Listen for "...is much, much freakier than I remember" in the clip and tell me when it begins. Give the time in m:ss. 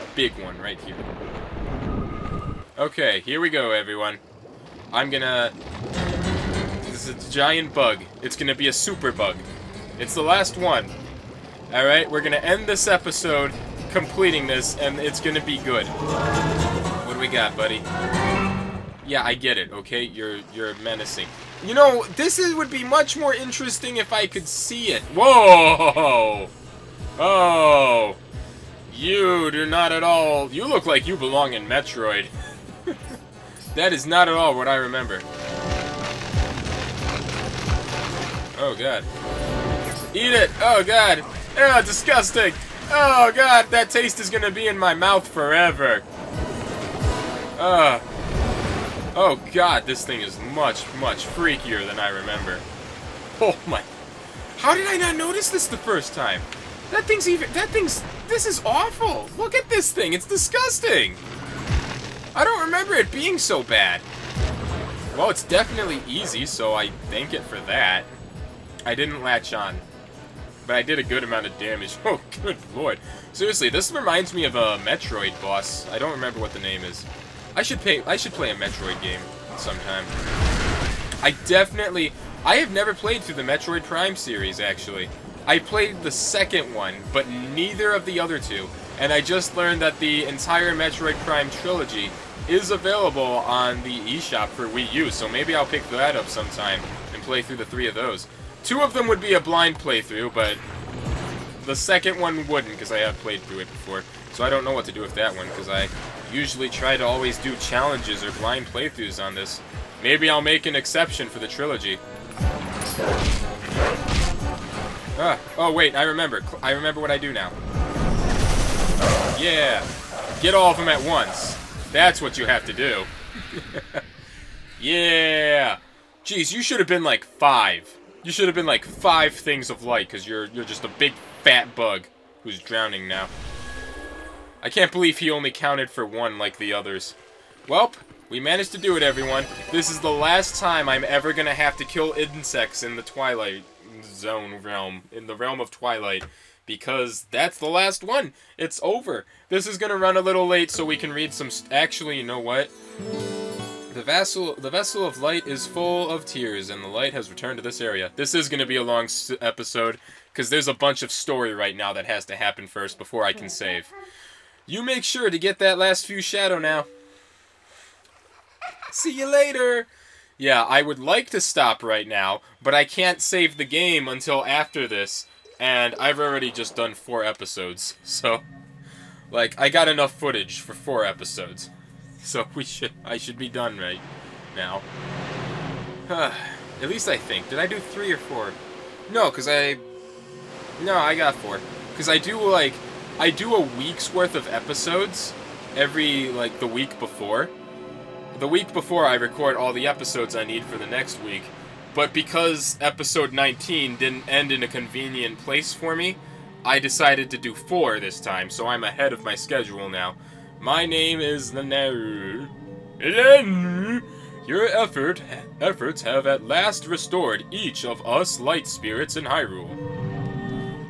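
0:50.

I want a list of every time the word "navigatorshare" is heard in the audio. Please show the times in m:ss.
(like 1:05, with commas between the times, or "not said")
not said.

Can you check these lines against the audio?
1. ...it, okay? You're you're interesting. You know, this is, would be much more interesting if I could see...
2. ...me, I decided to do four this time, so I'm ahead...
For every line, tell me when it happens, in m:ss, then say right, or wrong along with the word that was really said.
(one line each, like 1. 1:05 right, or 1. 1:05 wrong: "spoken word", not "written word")
1. 0:19 wrong: "menacing", not "interesting"
2. 3:25 right.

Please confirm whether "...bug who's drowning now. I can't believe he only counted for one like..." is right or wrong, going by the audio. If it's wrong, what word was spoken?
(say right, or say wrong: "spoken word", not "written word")
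right.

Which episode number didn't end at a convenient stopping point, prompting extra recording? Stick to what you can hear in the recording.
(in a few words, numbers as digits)
19.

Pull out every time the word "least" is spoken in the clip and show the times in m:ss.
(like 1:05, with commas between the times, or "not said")
3:06.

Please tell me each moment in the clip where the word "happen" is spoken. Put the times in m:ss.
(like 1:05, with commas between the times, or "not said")
2:42.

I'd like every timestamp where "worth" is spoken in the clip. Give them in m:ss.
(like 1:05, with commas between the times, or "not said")
3:14.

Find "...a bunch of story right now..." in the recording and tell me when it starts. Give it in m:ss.
2:40.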